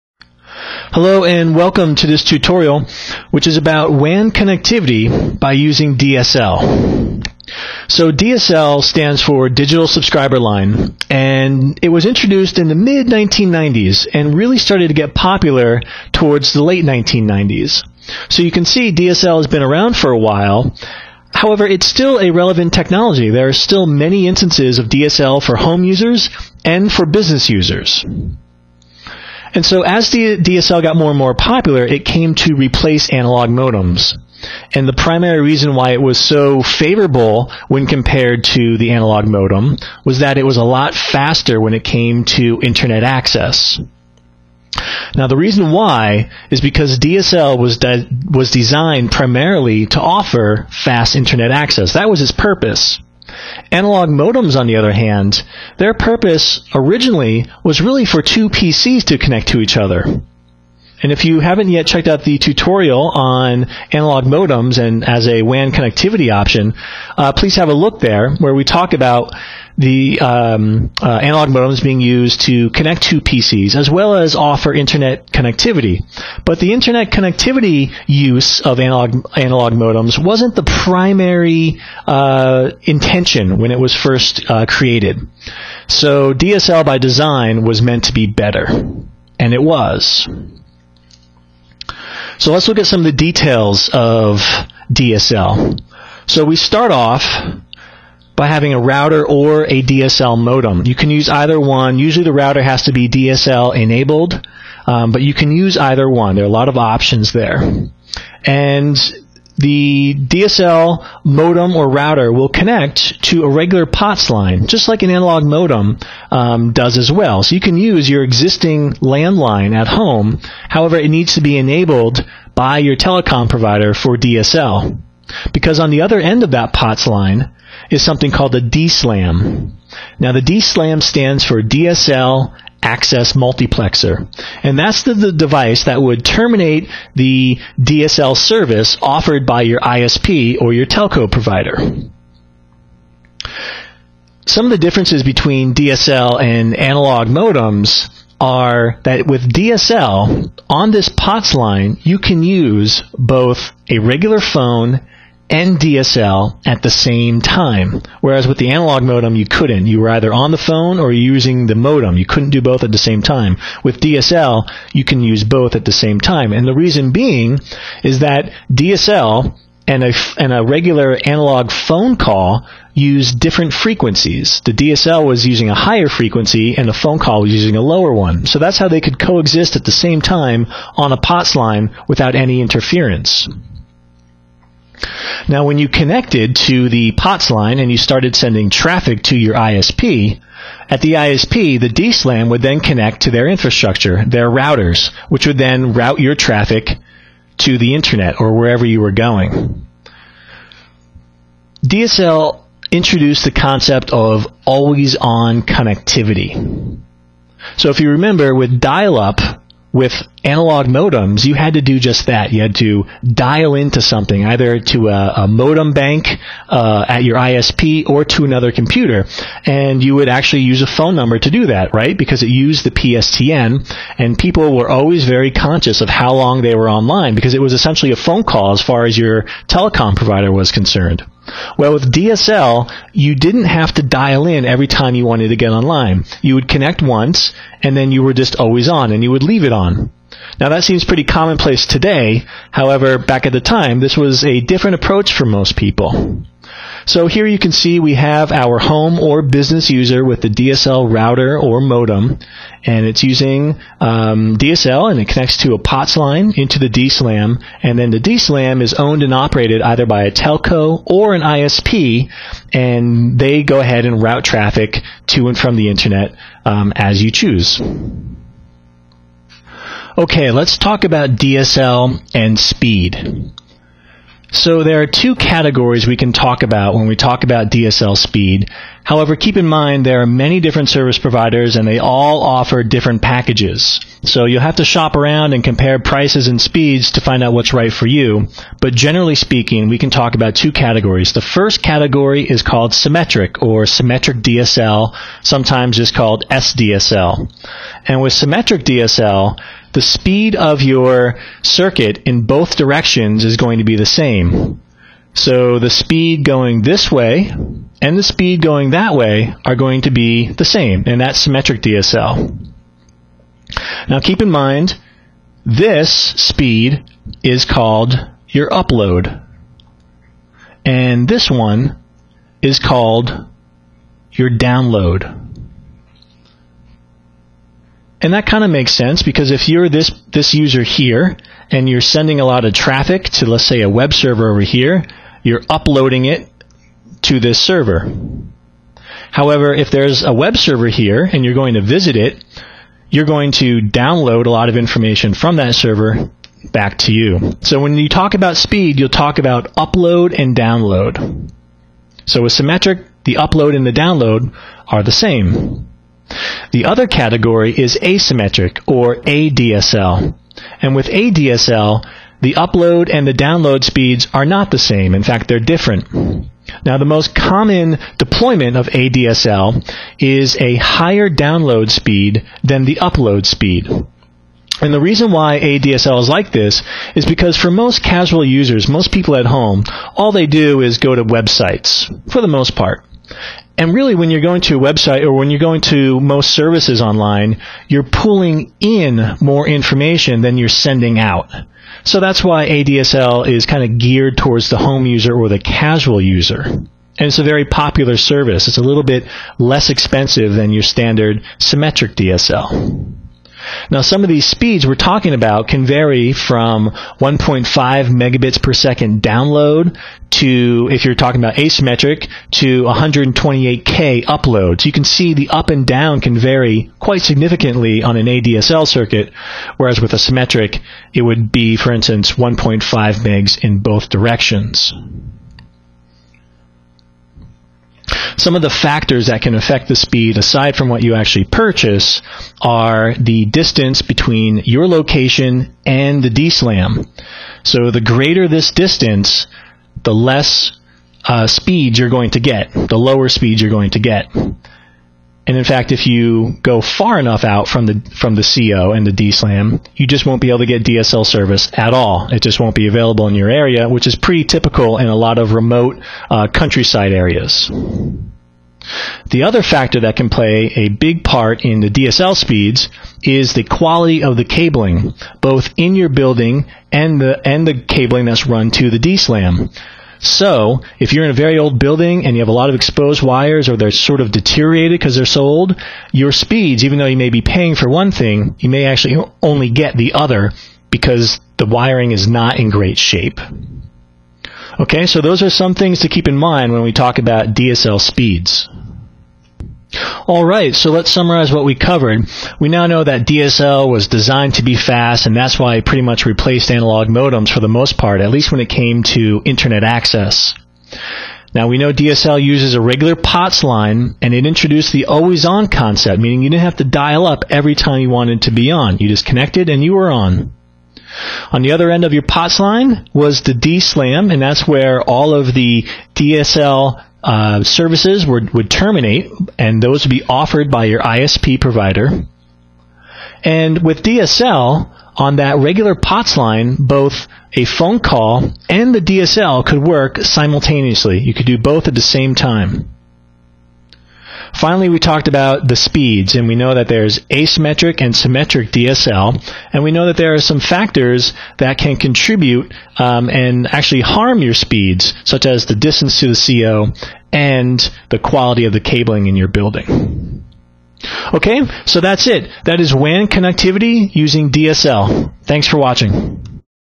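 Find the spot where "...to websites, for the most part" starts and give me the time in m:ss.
6:21.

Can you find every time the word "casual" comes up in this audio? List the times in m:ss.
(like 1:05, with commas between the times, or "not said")
6:18, 6:35.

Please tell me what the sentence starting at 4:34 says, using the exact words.
So there are two categories we can talk about when we talk about DSL speed.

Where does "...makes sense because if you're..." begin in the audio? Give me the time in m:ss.
5:28.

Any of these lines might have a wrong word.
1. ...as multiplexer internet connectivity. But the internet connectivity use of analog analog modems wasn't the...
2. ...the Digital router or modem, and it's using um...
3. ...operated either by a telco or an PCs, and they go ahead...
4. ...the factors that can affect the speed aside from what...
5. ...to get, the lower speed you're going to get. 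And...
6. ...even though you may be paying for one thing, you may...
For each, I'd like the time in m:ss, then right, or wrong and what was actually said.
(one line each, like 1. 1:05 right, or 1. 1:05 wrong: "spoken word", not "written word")
1. 1:14 wrong: "offer", not "multiplexer"
2. 4:10 wrong: "DSL", not "Digital"
3. 4:19 wrong: "ISP", not "PCs"
4. 7:08 right
5. 7:22 right
6. 7:56 right.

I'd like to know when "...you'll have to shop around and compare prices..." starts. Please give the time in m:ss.
4:44.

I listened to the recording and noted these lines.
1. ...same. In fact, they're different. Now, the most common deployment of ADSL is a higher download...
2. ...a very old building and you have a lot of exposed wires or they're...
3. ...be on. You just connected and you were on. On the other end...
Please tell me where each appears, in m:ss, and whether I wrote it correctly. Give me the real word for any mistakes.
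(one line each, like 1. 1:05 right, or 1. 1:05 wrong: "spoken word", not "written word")
1. 6:04 right
2. 7:51 right
3. 8:28 right.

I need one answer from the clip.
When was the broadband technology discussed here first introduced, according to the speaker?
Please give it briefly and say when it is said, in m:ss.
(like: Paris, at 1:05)
mid-1990s, at 0:12.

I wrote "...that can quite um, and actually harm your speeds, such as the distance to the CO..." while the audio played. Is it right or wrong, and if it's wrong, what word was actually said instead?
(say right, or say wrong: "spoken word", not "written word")
wrong: "contribute", not "quite".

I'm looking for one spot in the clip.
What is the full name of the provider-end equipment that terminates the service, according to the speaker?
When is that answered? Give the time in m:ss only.
2:11.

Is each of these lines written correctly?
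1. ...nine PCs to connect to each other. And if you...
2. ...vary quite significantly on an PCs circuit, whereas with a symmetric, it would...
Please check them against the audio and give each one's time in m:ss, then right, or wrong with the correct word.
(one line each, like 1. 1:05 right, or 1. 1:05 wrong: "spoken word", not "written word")
1. 0:58 wrong: "two", not "nine"
2. 6:56 wrong: "ADSL", not "PCs".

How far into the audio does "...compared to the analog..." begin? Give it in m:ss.
0:37.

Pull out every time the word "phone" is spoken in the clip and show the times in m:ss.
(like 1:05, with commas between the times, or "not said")
2:34, 2:40, 2:51, 2:56, 3:40, 3:48, 8:47.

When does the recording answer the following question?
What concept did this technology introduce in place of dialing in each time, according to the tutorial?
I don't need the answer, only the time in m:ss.
3:24.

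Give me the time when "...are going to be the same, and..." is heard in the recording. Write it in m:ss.
5:09.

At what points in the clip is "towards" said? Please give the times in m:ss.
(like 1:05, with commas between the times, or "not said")
0:16, 6:34.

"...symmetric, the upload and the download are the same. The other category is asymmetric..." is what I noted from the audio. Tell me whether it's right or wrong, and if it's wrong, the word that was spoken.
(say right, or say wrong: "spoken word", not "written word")
right.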